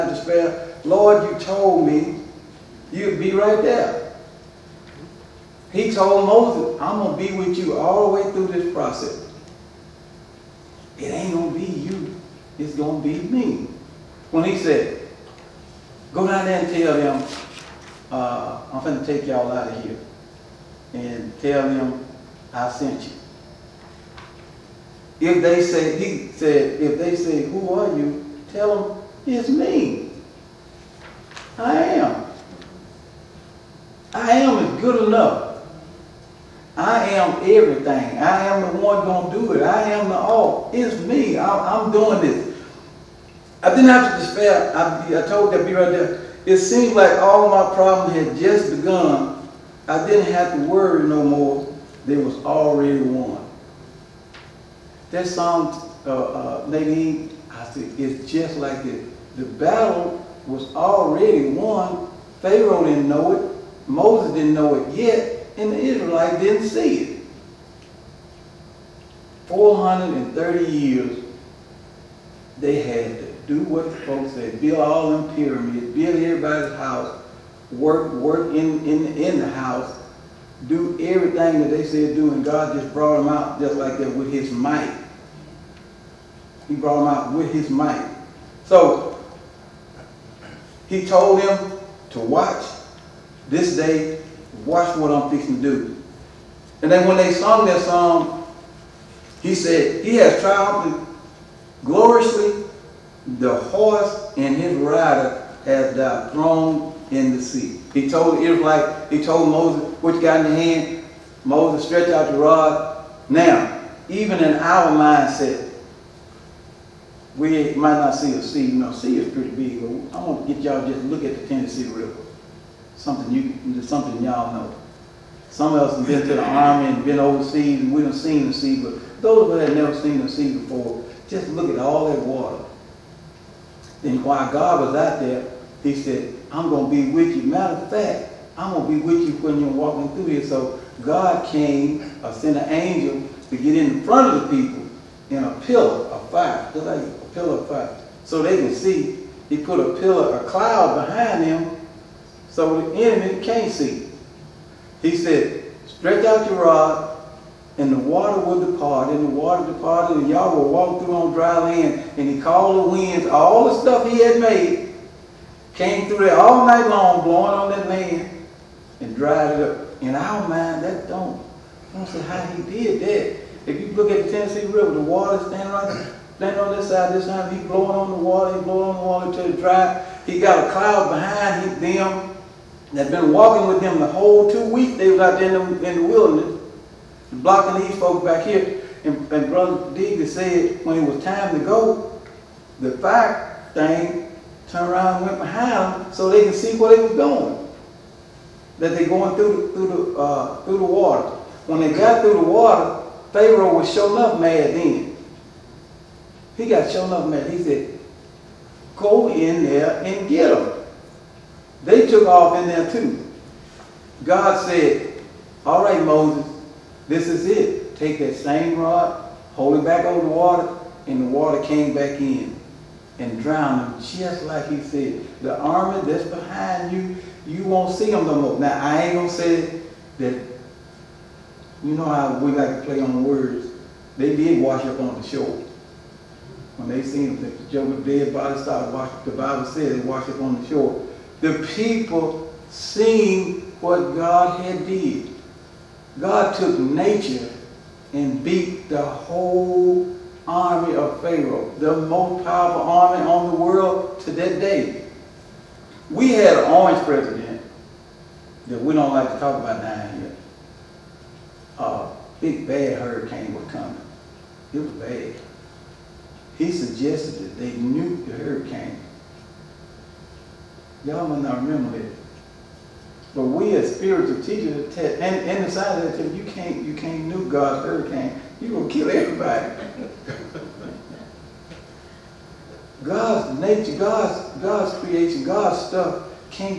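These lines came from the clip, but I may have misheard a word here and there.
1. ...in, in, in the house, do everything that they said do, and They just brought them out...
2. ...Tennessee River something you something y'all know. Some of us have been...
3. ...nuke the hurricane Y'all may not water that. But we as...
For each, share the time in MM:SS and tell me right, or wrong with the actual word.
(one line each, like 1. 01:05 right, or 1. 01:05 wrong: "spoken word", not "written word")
1. 01:18 wrong: "God", not "They"
2. 02:01 right
3. 04:27 wrong: "remember", not "water".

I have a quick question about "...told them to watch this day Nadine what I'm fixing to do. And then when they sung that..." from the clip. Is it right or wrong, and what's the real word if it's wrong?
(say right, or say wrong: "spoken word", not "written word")
wrong: "Watch", not "Nadine".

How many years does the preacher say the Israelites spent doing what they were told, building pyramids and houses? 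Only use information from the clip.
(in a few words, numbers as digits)
430.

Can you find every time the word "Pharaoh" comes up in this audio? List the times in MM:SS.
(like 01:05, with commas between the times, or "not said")
01:02, 03:23, 04:11.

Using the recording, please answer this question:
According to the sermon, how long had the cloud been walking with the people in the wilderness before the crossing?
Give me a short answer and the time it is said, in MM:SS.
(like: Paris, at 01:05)
Two weeks, at 03:04.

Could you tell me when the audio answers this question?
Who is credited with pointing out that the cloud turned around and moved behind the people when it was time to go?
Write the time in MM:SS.
03:09.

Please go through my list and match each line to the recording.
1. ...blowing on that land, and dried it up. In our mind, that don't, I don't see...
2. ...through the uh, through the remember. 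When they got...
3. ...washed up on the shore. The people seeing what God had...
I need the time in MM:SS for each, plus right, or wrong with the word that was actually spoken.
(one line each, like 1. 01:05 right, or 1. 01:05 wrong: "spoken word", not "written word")
1. 02:47 right
2. 03:19 wrong: "water", not "remember"
3. 04:00 right.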